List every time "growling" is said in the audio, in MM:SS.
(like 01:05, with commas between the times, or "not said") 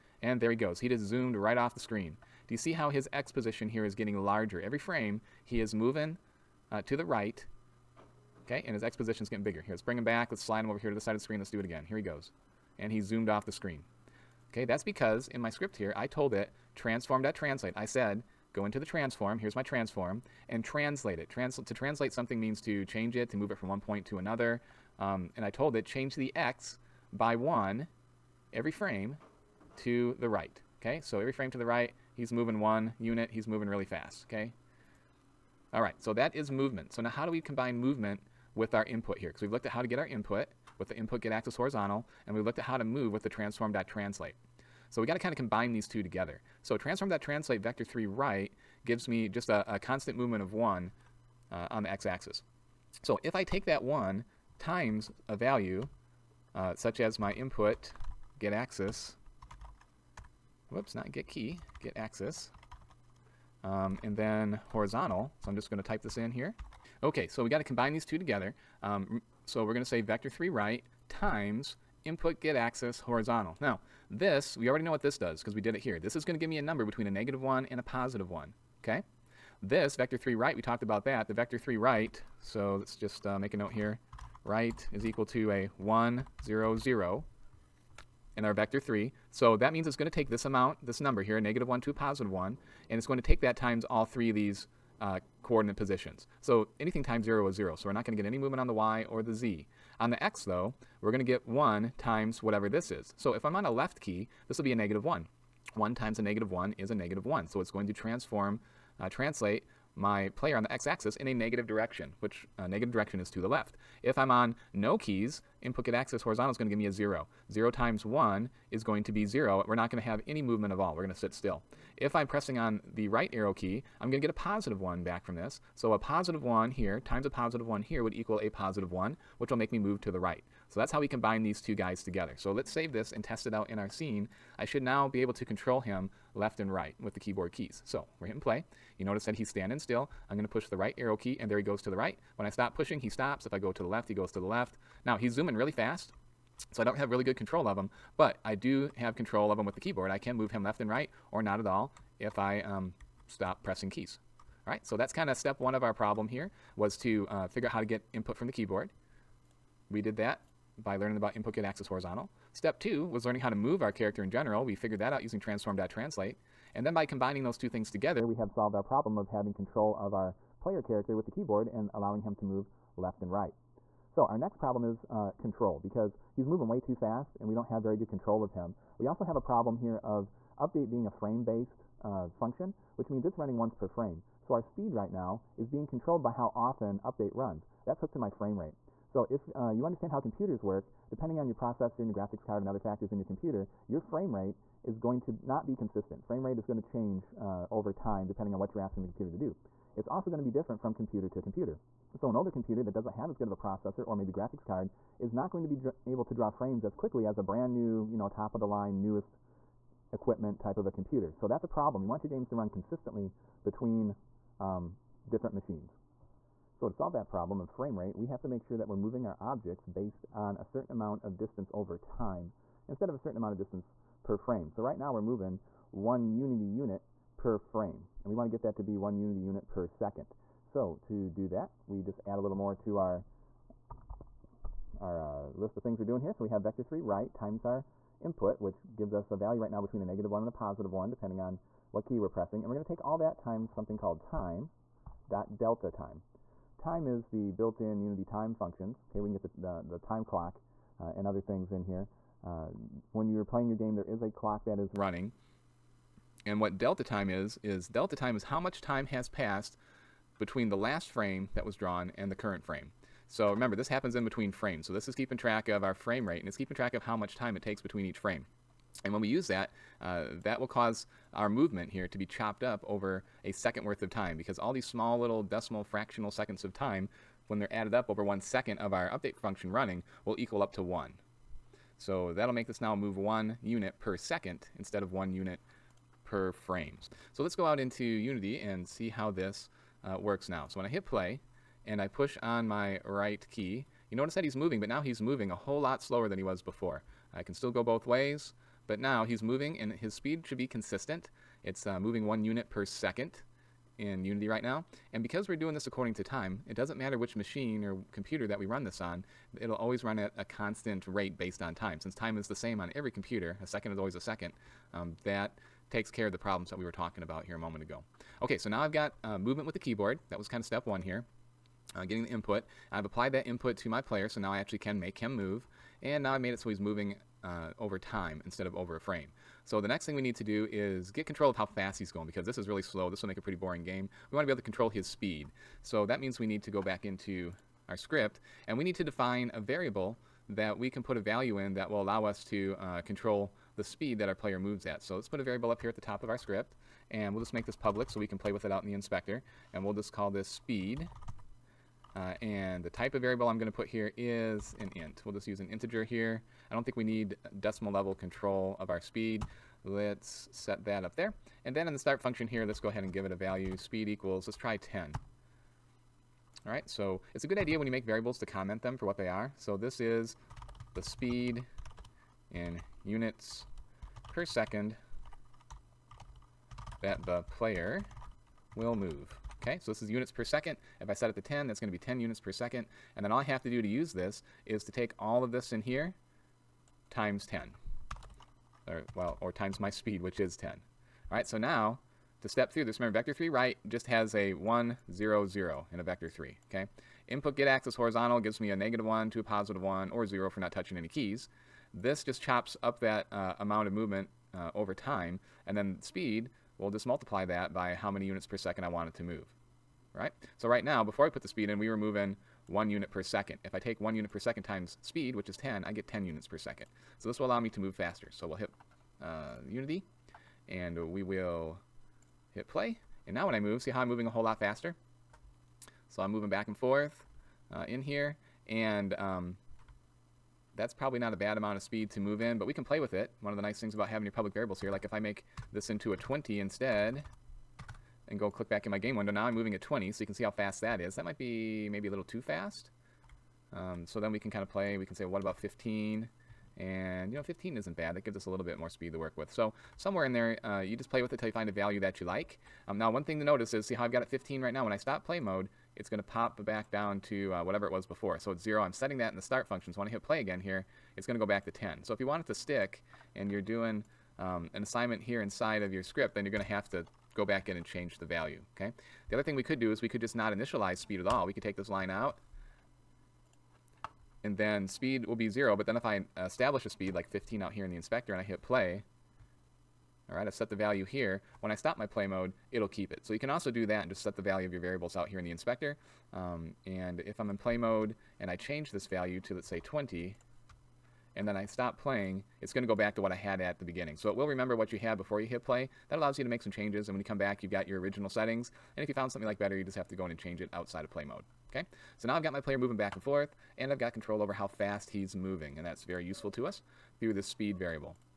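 not said.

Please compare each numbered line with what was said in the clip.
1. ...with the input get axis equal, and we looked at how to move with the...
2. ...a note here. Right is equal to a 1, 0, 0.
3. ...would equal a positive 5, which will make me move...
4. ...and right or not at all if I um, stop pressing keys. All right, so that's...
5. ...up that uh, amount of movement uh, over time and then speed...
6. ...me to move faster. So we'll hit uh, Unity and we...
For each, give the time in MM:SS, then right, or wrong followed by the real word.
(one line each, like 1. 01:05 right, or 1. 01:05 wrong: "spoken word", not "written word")
1. 00:40 wrong: "horizontal", not "equal"
2. 01:23 right
3. 02:08 wrong: "1", not "5"
4. 02:30 right
5. 06:42 right
6. 06:57 right.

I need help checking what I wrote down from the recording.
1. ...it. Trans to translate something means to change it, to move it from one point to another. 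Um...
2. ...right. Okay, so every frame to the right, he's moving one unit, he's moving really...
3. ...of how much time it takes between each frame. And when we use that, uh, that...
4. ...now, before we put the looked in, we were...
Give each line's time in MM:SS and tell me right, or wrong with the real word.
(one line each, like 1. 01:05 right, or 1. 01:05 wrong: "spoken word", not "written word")
1. 00:21 right
2. 00:30 right
3. 04:26 right
4. 06:50 wrong: "speed", not "looked".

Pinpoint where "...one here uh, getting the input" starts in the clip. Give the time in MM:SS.
05:20.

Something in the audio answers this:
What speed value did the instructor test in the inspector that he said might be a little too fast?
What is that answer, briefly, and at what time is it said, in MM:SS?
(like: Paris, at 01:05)
20, at 07:15.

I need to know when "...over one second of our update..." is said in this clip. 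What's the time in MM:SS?
04:38.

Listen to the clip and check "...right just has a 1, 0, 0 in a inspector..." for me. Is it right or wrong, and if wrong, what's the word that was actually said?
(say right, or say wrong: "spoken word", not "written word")
wrong: "vector", not "inspector".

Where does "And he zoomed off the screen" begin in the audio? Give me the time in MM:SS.
00:12.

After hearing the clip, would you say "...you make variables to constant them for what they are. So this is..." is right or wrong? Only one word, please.
wrong.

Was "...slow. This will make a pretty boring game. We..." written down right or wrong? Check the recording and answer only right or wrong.
right.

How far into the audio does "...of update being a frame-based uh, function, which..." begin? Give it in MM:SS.
03:00.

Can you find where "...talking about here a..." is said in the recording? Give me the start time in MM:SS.
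05:16.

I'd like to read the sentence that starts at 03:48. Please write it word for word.
And we want to get that to be one unity unit per second.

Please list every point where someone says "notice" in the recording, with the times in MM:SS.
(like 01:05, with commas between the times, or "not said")
02:19, 04:54, 07:33.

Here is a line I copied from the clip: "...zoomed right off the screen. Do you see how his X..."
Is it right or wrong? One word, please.
right.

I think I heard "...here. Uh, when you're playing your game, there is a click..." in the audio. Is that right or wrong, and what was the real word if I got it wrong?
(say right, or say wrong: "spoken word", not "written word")
wrong: "clock", not "click".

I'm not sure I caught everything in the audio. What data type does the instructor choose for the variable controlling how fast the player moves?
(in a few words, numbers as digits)
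int.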